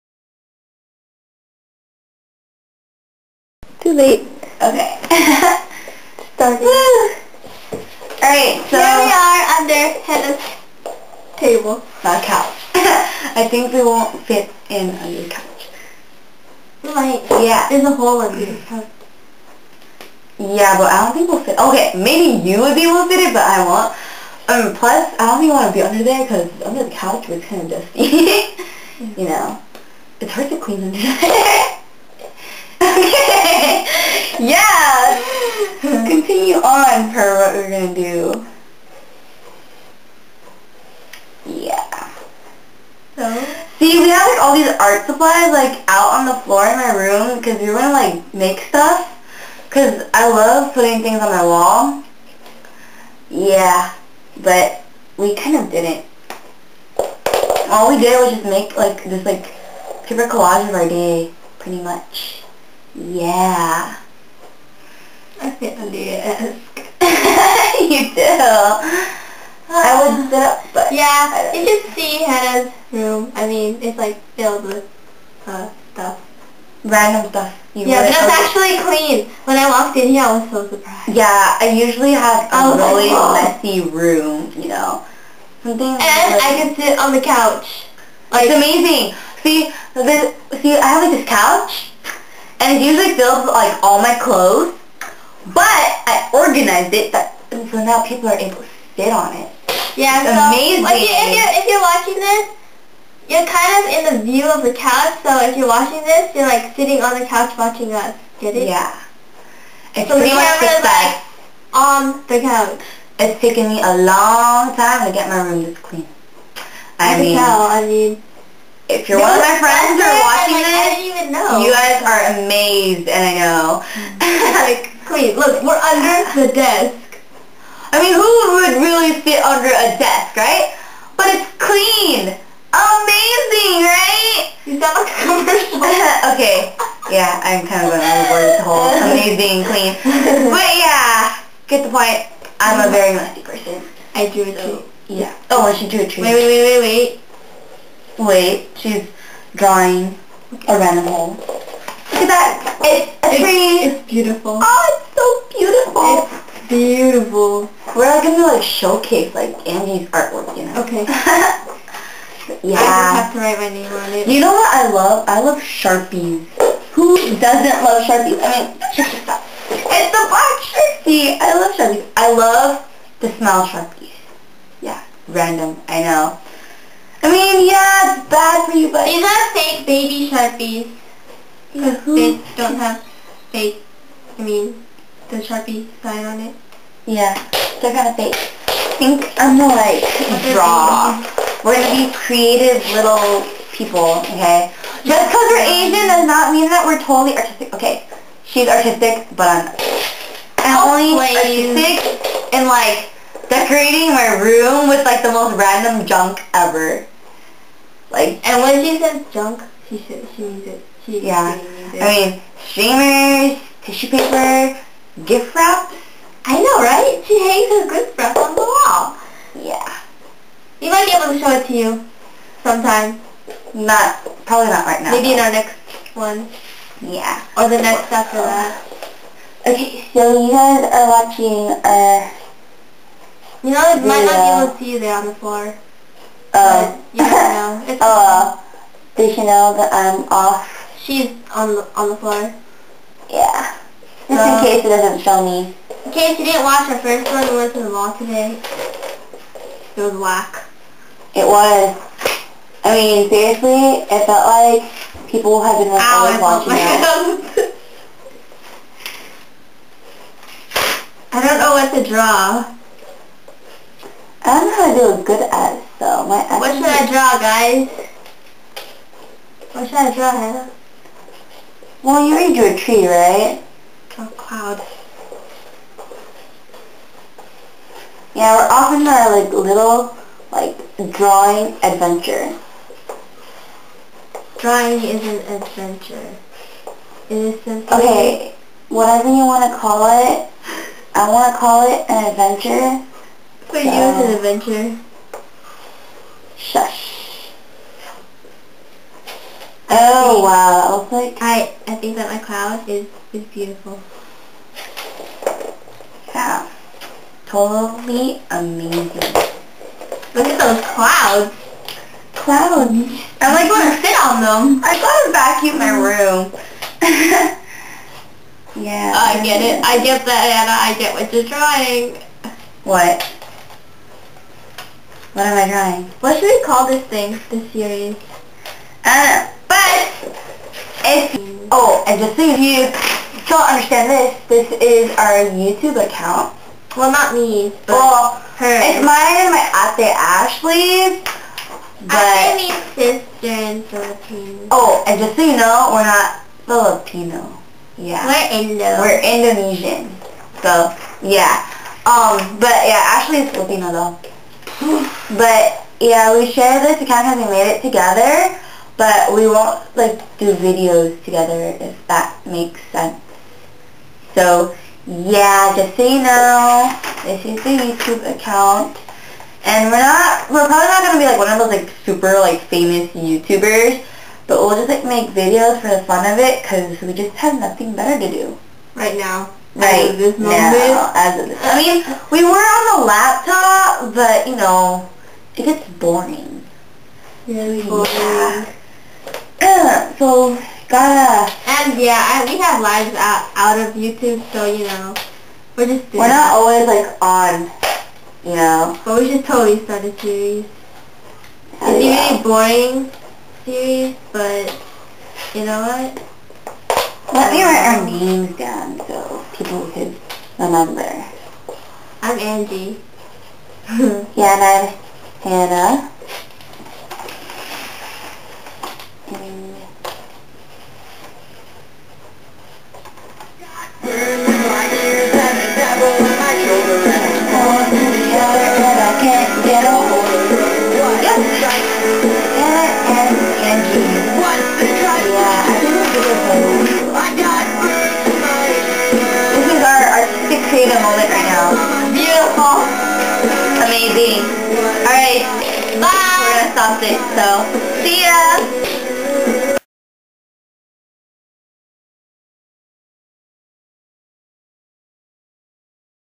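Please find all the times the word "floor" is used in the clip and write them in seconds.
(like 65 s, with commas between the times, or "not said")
46 s, 235 s, 242 s.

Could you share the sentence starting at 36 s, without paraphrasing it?
on for what we're going to do.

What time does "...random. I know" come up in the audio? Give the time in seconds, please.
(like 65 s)
175 s.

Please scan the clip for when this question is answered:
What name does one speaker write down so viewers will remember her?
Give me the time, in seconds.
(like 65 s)
412 s.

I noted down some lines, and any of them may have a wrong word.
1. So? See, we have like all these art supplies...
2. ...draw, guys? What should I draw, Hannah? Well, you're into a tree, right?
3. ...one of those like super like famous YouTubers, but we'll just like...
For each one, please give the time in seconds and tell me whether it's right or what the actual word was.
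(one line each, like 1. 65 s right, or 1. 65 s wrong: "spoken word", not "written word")
1. 43 s right
2. 267 s right
3. 371 s right.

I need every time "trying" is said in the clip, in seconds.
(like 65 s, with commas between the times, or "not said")
321 s.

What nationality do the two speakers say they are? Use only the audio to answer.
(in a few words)
Indonesian.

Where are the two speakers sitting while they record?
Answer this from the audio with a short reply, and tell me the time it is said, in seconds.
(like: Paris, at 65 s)
Under Heather's table, at 9 s.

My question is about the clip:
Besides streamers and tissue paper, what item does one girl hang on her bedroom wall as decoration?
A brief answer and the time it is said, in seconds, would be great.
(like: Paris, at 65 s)
Gift wrap, at 215 s.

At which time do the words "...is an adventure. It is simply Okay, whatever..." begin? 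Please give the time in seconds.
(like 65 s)
285 s.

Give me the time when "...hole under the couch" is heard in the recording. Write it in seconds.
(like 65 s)
17 s.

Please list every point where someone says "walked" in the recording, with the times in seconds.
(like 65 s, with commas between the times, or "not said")
79 s.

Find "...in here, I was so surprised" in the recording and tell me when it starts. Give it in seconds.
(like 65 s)
79 s.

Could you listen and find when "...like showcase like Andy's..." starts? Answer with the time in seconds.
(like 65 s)
158 s.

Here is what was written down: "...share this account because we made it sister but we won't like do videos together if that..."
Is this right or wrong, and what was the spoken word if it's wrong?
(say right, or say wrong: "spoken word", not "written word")
wrong: "together", not "sister".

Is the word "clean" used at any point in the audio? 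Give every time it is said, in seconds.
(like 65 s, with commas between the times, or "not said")
30 s, 78 s, 115 s, 131 s, 139 s.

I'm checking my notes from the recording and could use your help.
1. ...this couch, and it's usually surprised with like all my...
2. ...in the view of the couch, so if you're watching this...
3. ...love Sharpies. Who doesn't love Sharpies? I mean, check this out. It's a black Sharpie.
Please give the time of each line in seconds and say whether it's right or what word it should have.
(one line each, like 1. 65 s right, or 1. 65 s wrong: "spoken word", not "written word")
1. 91 s wrong: "filled", not "surprised"
2. 103 s right
3. 165 s right.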